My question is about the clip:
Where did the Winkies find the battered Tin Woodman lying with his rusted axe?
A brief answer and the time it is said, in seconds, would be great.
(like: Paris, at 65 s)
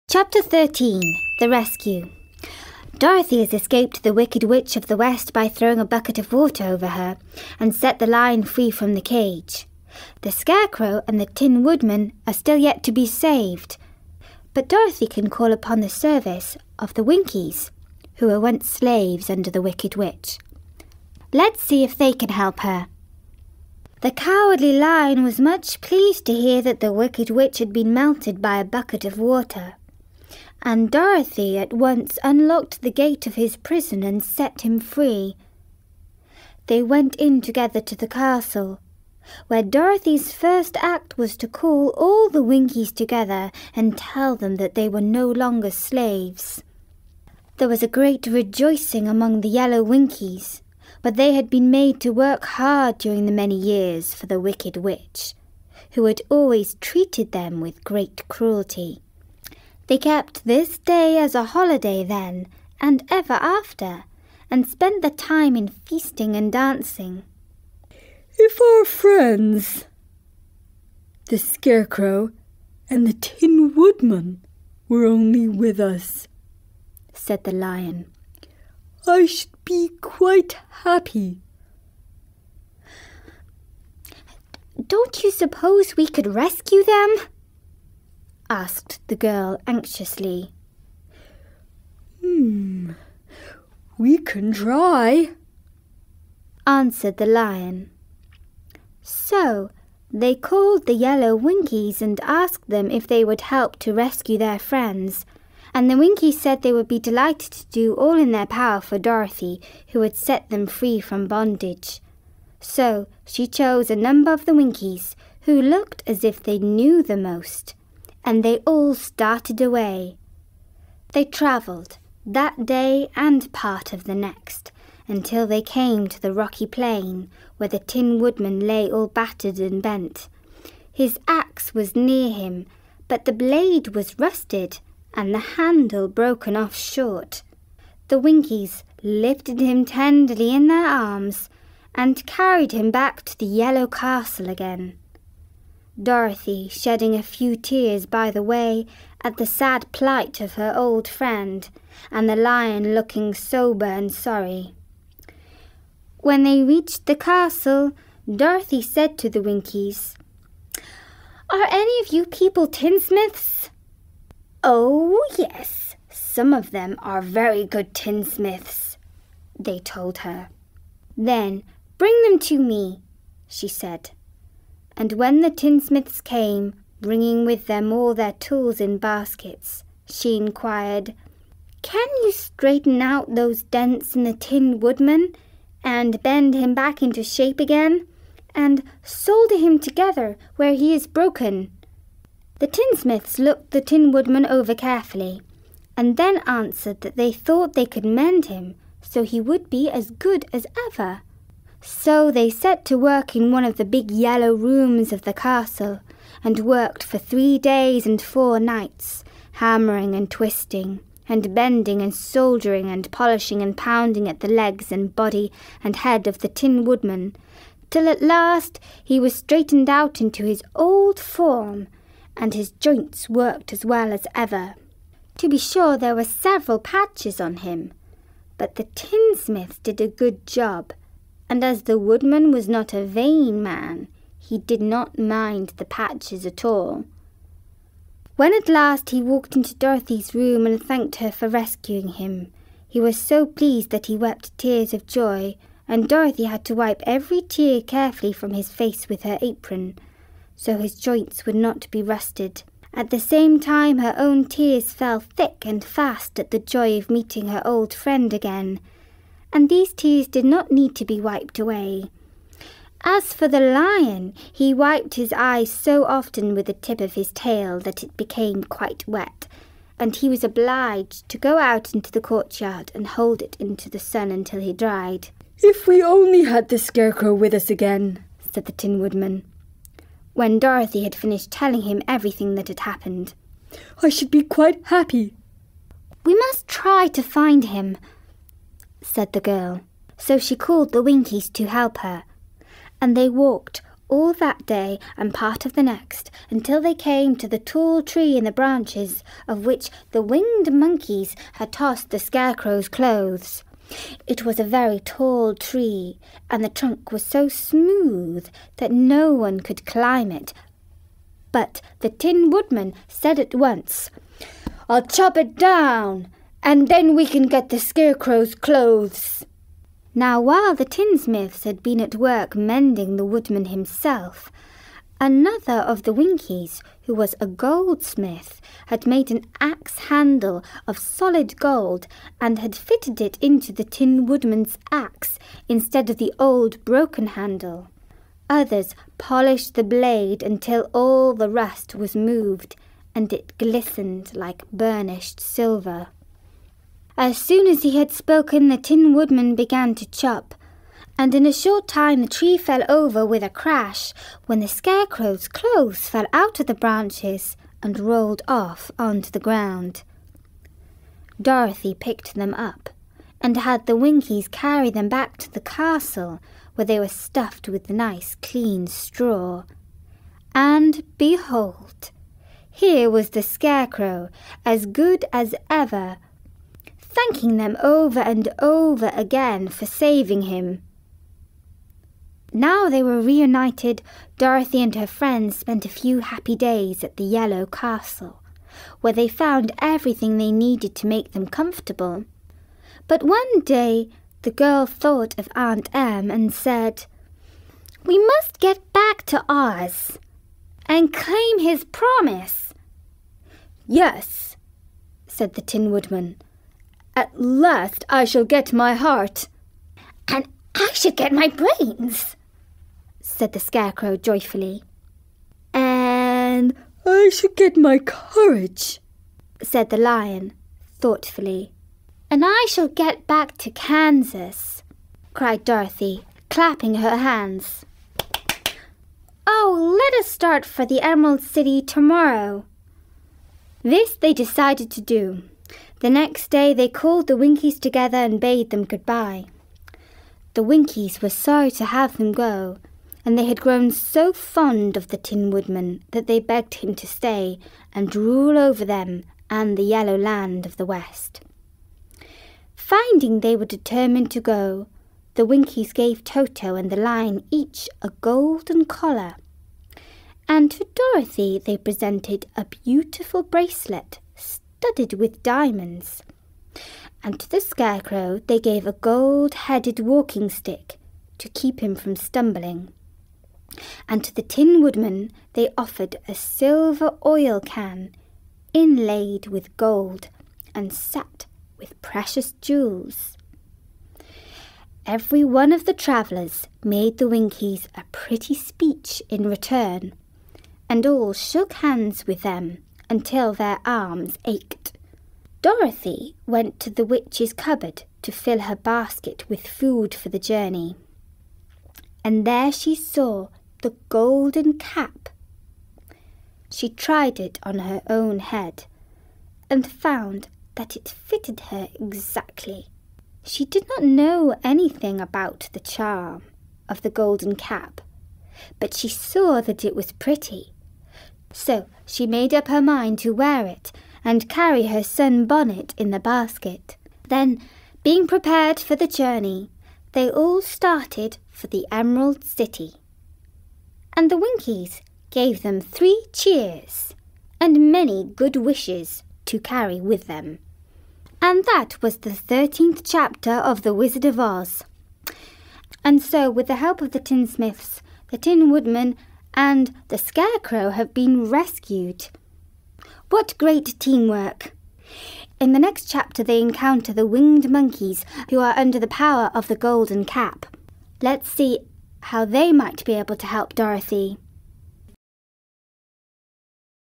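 The rocky plain, at 126 s.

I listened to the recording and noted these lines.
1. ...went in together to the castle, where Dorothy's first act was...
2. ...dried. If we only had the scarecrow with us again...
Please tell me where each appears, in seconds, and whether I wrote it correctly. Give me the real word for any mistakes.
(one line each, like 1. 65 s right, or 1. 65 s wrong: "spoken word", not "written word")
1. 36 s right
2. 274 s right.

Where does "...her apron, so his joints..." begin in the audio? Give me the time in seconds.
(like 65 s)
249 s.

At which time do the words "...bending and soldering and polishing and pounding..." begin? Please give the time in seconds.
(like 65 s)
211 s.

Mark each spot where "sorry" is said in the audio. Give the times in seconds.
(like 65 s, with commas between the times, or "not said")
154 s, 441 s.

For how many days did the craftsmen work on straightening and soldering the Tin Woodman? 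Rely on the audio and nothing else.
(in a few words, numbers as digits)
3 days.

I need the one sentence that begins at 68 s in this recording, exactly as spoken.
If our friends, the Scarecrow and the Tin Woodman, were only with us, said the Lion, I should be quite happy.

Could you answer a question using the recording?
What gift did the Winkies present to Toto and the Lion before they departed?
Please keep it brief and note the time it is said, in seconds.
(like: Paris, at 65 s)
Golden collar, at 458 s.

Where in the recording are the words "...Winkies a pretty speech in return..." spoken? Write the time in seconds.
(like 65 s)
487 s.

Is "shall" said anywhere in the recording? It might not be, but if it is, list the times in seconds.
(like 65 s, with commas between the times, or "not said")
408 s, 422 s.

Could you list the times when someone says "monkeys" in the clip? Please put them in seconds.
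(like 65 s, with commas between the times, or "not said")
300 s, 557 s.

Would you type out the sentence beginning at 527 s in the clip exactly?
Then, being prepared for the journey, they all started for the Emerald City.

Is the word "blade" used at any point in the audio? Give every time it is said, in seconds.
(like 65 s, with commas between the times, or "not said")
133 s, 339 s.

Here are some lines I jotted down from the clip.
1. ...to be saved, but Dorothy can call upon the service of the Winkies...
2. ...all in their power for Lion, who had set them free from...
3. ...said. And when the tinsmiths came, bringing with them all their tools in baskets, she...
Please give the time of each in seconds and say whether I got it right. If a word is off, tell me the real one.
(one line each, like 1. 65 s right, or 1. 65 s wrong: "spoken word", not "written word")
1. 12 s right
2. 107 s wrong: "Dorothy", not "Lion"
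3. 173 s right.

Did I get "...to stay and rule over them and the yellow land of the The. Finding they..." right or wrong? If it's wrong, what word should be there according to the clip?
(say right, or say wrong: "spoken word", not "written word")
wrong: "West", not "The".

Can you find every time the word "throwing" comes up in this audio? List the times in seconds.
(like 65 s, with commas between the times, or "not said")
5 s.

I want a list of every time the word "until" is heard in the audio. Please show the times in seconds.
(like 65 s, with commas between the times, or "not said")
125 s, 274 s, 296 s, 340 s, 493 s.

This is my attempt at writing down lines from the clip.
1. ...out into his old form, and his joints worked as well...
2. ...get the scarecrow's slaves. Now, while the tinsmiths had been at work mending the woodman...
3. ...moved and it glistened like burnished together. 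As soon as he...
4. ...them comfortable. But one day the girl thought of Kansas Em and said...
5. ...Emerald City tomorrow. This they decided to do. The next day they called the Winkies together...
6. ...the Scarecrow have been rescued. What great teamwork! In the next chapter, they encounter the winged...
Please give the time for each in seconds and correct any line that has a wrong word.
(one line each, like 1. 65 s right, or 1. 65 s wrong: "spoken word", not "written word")
1. 219 s right
2. 317 s wrong: "clothes", not "slaves"
3. 342 s wrong: "silver", not "together"
4. 391 s wrong: "Aunt", not "Kansas"
5. 431 s right
6. 550 s right.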